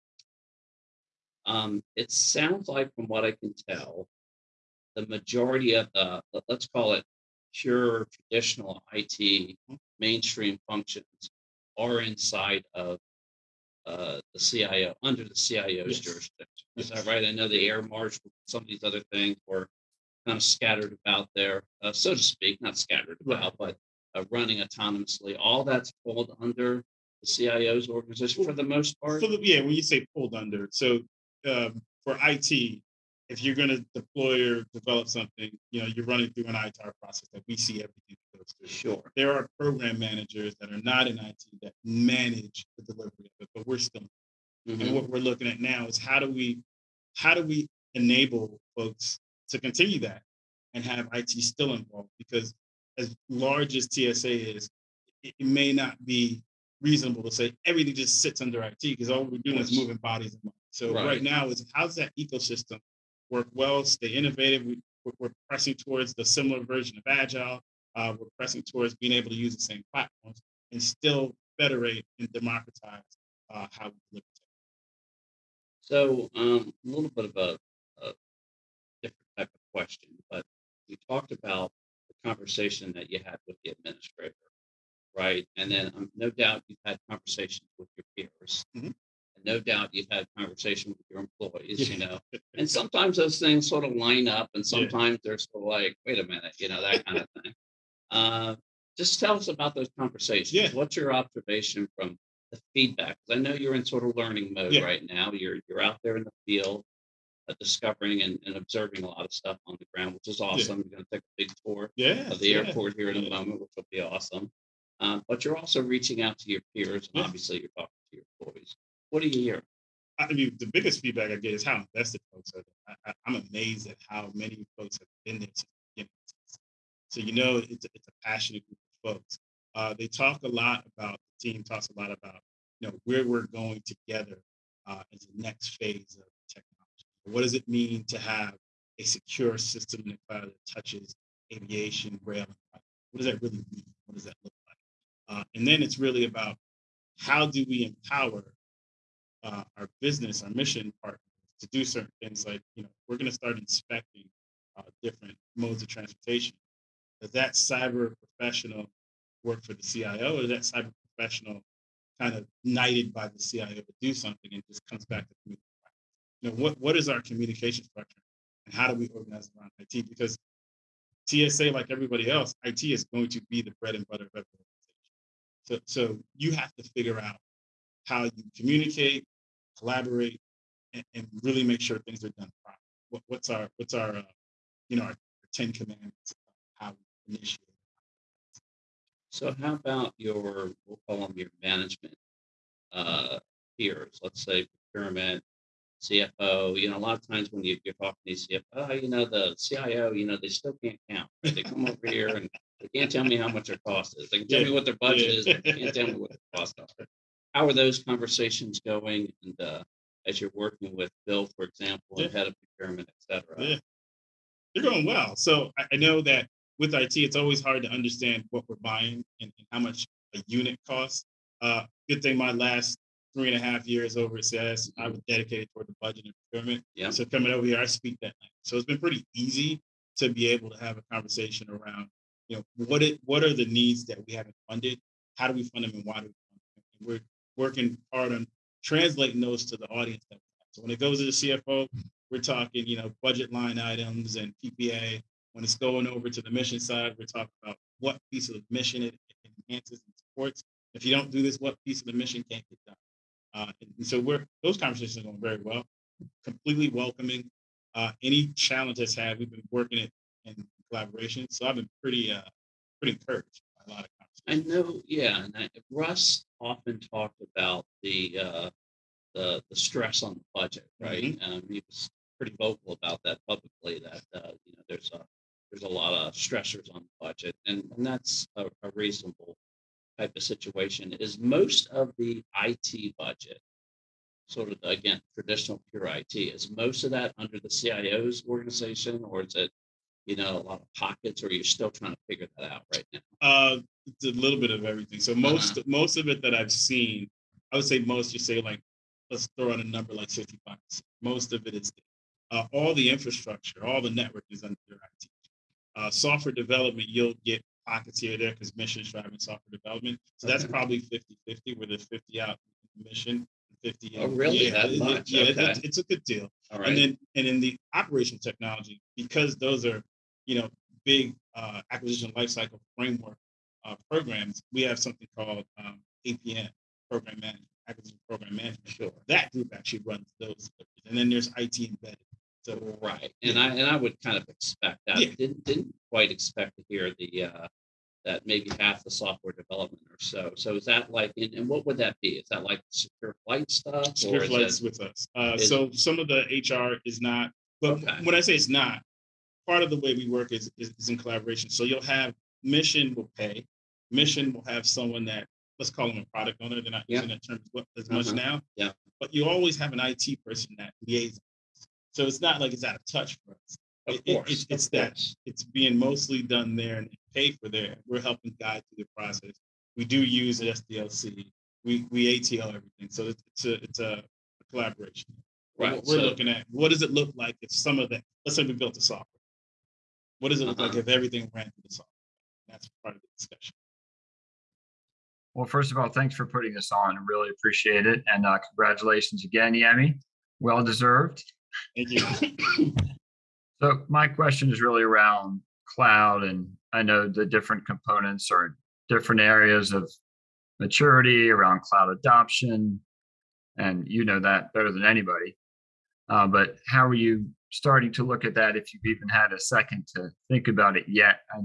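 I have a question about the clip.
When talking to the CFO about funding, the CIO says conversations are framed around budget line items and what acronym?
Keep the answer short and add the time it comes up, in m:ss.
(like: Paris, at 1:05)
PPA, at 4:04.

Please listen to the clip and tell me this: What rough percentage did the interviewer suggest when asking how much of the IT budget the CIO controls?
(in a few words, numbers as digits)
55.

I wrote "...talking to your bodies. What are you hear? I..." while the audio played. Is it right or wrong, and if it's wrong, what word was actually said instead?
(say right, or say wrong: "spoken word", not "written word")
wrong: "employees", not "bodies".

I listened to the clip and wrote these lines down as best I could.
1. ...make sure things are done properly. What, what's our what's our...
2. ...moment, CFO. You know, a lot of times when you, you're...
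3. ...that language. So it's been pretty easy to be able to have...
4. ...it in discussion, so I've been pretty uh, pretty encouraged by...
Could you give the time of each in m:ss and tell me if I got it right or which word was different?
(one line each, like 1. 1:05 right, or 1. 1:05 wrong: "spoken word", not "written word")
1. 3:01 right
2. 3:14 wrong: "procurement", not "moment"
3. 3:48 right
4. 4:19 wrong: "collaboration", not "discussion".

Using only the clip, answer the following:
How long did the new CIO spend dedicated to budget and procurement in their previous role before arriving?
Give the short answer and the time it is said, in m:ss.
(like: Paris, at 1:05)
3.5 years, at 3:43.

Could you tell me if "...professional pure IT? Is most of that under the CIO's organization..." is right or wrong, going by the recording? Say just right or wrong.
wrong.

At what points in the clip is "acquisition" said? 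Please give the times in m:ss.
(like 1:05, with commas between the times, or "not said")
5:21, 5:27.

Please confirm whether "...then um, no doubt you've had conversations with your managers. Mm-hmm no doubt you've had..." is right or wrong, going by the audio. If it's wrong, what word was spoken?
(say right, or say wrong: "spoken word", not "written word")
wrong: "peers", not "managers".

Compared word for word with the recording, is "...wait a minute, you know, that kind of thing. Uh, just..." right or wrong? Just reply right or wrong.
right.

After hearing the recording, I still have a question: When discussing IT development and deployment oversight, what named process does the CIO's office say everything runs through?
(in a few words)
ITAR.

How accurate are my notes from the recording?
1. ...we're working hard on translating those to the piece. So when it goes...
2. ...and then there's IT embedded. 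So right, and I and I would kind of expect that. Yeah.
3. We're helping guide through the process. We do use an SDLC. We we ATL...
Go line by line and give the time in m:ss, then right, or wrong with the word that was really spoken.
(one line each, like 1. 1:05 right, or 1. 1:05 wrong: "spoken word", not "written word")
1. 3:57 wrong: "audience", not "piece"
2. 5:31 right
3. 6:08 right.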